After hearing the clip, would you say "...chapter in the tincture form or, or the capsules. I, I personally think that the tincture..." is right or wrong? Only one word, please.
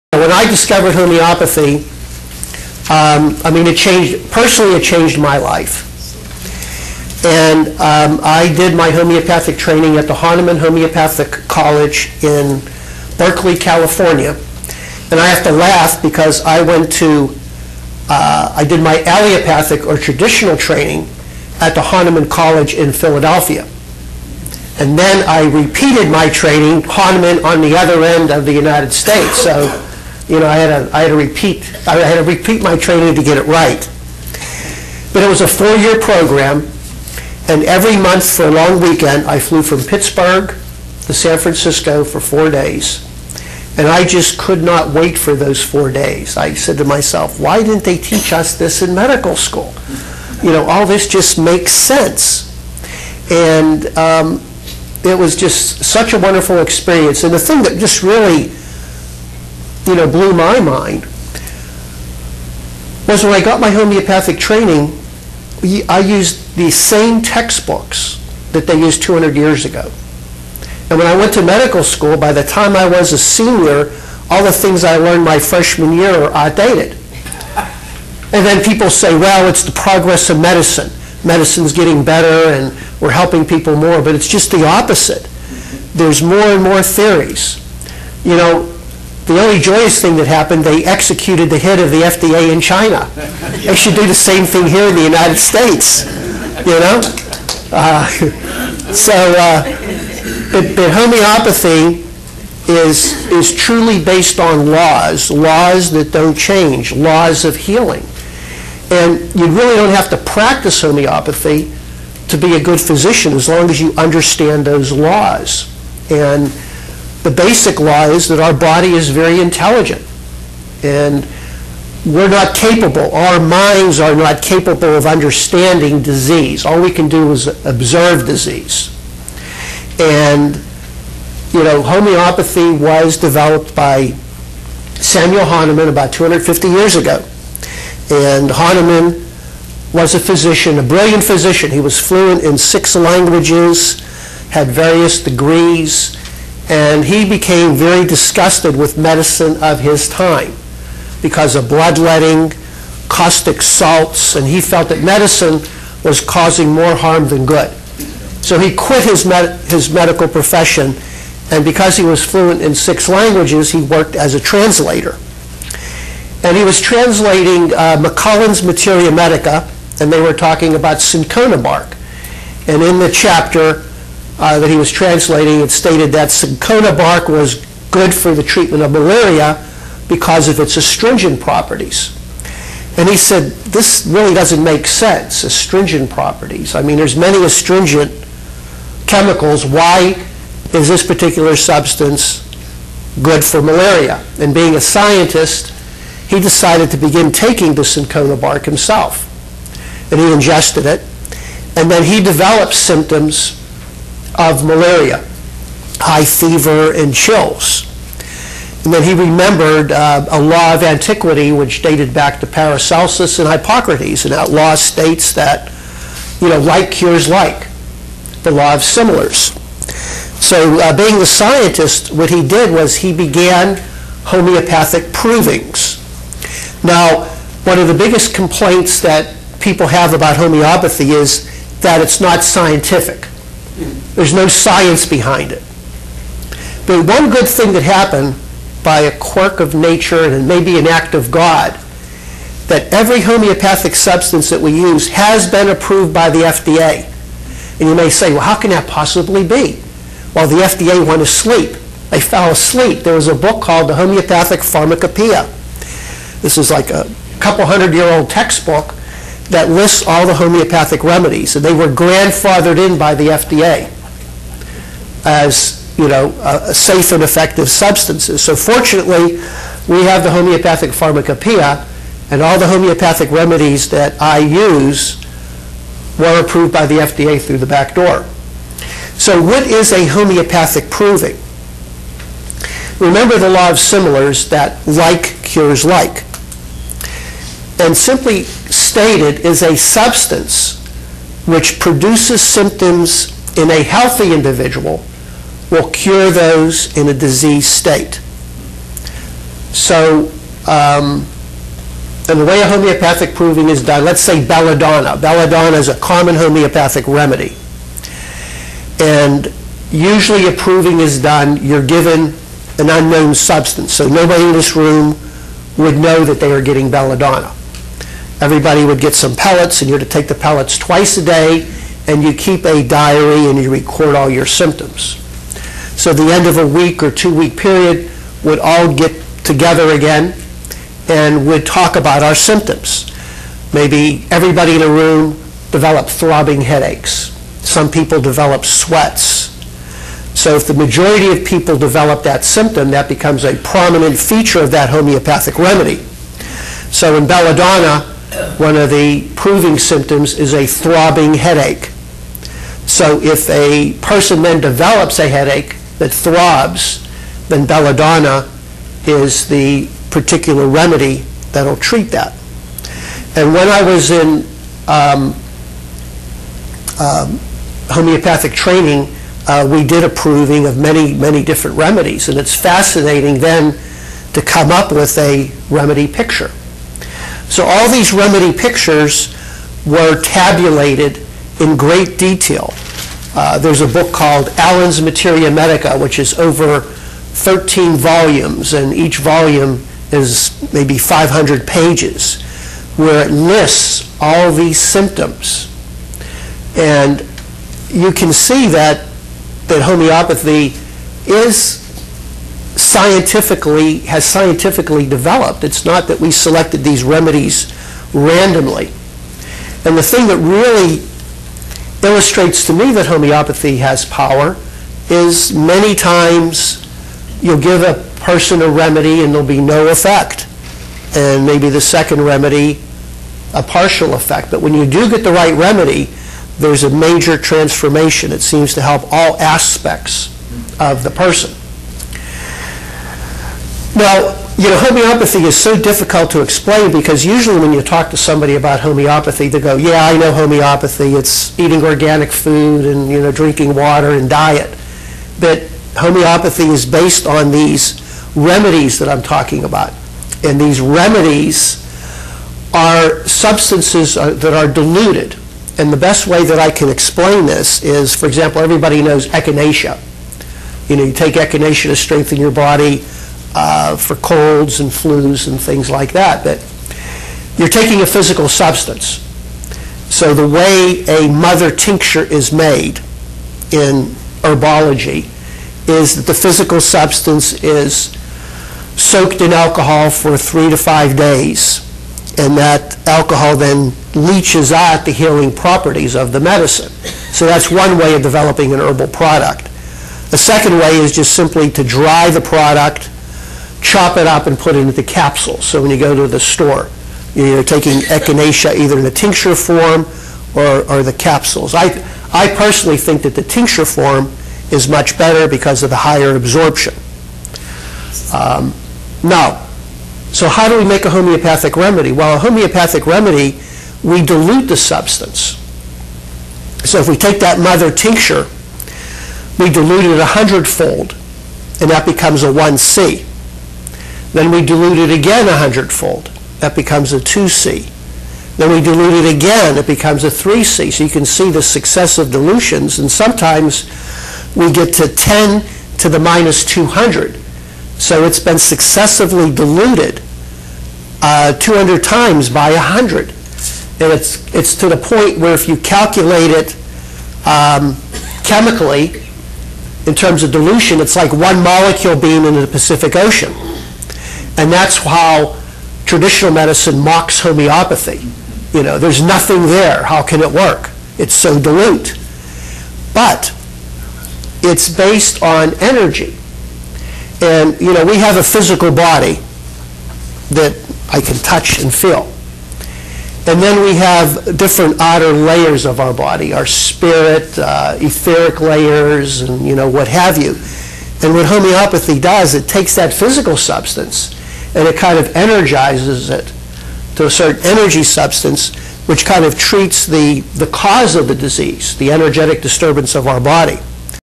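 wrong.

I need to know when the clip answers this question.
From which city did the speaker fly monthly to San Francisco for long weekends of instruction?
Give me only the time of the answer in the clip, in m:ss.
0:39.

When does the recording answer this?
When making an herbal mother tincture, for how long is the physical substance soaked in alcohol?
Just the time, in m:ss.
8:00.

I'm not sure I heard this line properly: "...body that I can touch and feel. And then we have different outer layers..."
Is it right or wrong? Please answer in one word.
right.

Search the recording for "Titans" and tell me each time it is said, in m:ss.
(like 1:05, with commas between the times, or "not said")
not said.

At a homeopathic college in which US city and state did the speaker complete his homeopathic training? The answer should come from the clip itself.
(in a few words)
Berkeley, California.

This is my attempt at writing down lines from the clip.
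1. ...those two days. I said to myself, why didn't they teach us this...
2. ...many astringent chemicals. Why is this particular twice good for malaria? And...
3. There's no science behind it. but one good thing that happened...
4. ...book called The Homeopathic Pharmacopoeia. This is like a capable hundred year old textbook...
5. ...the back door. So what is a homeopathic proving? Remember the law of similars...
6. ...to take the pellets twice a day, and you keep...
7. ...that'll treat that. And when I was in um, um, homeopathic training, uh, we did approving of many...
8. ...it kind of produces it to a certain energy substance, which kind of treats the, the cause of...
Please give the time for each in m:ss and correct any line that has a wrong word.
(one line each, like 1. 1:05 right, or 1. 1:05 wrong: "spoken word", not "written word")
1. 0:45 wrong: "four", not "two"
2. 3:07 wrong: "substance", not "twice"
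3. 3:54 right
4. 4:13 wrong: "couple", not "capable"
5. 4:37 right
6. 5:19 right
7. 6:01 right
8. 9:44 wrong: "energizes", not "produces".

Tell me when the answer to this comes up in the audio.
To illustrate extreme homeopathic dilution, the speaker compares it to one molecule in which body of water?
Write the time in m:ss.
9:12.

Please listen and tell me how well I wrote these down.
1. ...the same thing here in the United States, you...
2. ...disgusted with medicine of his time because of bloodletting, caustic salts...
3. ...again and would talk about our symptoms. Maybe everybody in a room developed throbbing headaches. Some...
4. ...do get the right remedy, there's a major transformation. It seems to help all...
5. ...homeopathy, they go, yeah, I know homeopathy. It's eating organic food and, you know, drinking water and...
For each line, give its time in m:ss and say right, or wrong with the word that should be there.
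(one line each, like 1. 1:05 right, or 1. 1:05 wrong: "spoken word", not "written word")
1. 1:34 right
2. 2:28 right
3. 5:29 right
4. 7:04 right
5. 7:18 right.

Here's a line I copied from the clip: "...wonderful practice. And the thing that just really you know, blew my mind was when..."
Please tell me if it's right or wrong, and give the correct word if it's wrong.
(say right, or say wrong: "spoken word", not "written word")
wrong: "experience", not "practice".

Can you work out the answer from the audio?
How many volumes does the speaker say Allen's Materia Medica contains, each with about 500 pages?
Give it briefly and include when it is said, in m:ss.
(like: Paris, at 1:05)
over 13, at 6:26.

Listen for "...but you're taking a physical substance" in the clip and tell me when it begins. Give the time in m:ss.
7:46.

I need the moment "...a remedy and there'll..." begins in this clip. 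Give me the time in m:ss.
6:58.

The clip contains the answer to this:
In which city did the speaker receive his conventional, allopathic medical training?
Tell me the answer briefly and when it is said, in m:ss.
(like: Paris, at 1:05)
Philadelphia, at 0:22.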